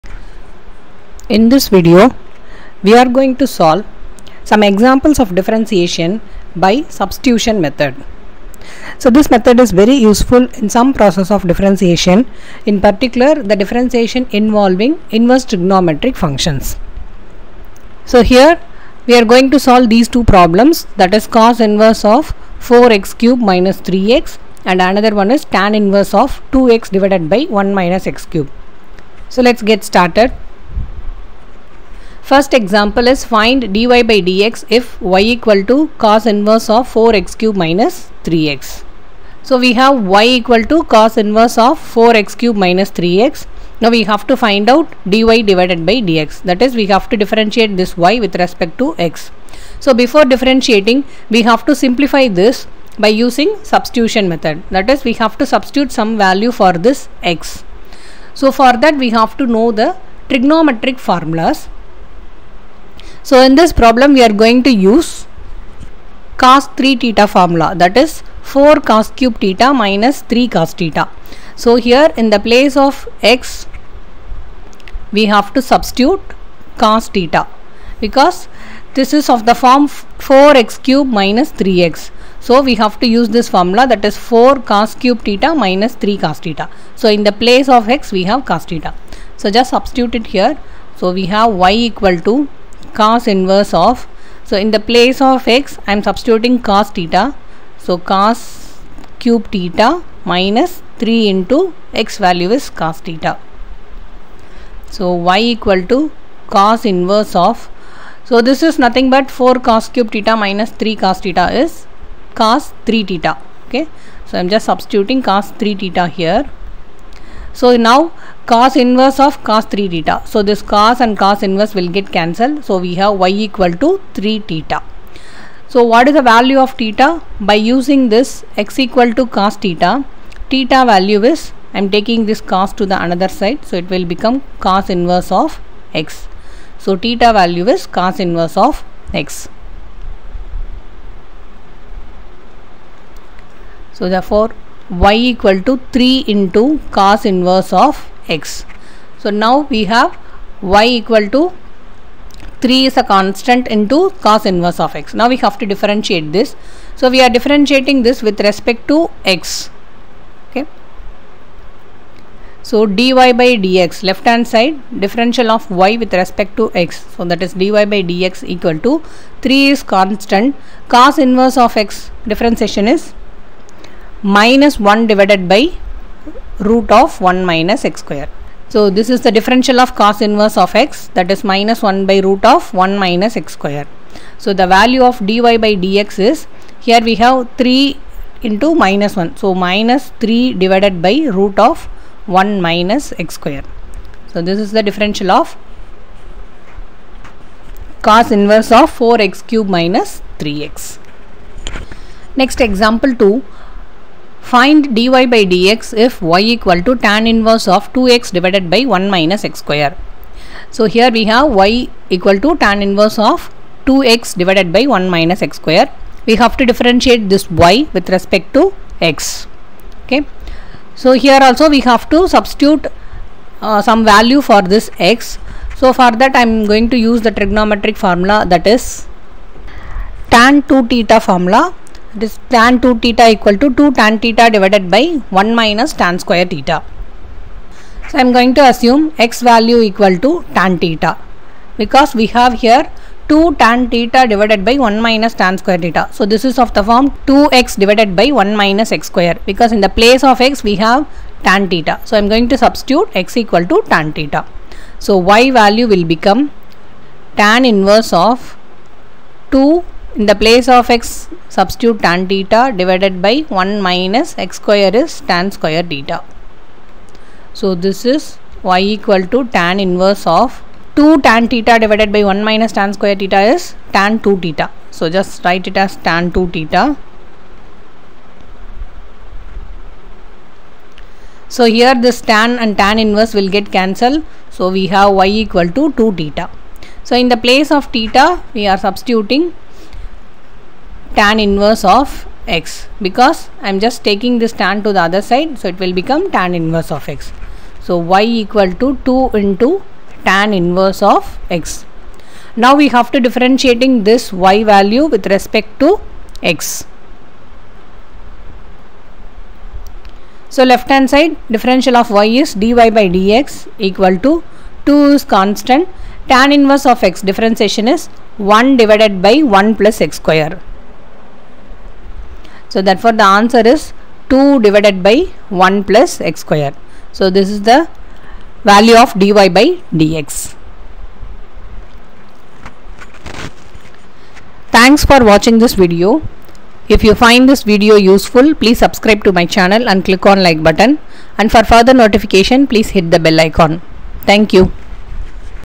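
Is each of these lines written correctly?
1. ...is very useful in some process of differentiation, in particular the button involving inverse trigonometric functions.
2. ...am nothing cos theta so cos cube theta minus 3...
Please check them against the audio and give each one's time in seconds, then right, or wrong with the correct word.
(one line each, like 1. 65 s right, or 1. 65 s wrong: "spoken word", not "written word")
1. 9 s wrong: "differentiation", not "button"
2. 95 s wrong: "substituting", not "nothing".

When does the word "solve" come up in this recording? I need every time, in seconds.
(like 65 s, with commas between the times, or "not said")
3 s, 19 s.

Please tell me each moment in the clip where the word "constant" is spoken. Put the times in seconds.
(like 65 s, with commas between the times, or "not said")
153 s, 169 s, 315 s.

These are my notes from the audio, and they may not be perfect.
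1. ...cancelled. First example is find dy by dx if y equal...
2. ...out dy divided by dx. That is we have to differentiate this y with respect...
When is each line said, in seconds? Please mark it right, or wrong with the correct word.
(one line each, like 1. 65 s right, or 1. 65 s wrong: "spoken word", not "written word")
1. 29 s wrong: "started", not "cancelled"
2. 44 s right.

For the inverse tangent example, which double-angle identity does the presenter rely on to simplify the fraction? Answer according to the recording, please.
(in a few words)
tan 2 theta formula.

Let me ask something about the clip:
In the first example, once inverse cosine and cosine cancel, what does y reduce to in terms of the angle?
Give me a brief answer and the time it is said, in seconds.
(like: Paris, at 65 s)
3 theta, at 123 s.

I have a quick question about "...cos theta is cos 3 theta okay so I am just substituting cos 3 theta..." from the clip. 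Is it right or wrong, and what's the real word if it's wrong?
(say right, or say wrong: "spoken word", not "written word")
right.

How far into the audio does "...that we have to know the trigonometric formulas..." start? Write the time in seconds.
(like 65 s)
58 s.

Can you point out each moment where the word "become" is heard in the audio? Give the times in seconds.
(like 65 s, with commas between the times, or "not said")
134 s, 256 s, 295 s.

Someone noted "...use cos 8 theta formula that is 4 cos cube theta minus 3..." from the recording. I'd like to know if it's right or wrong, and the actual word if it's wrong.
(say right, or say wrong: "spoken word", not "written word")
wrong: "3", not "8".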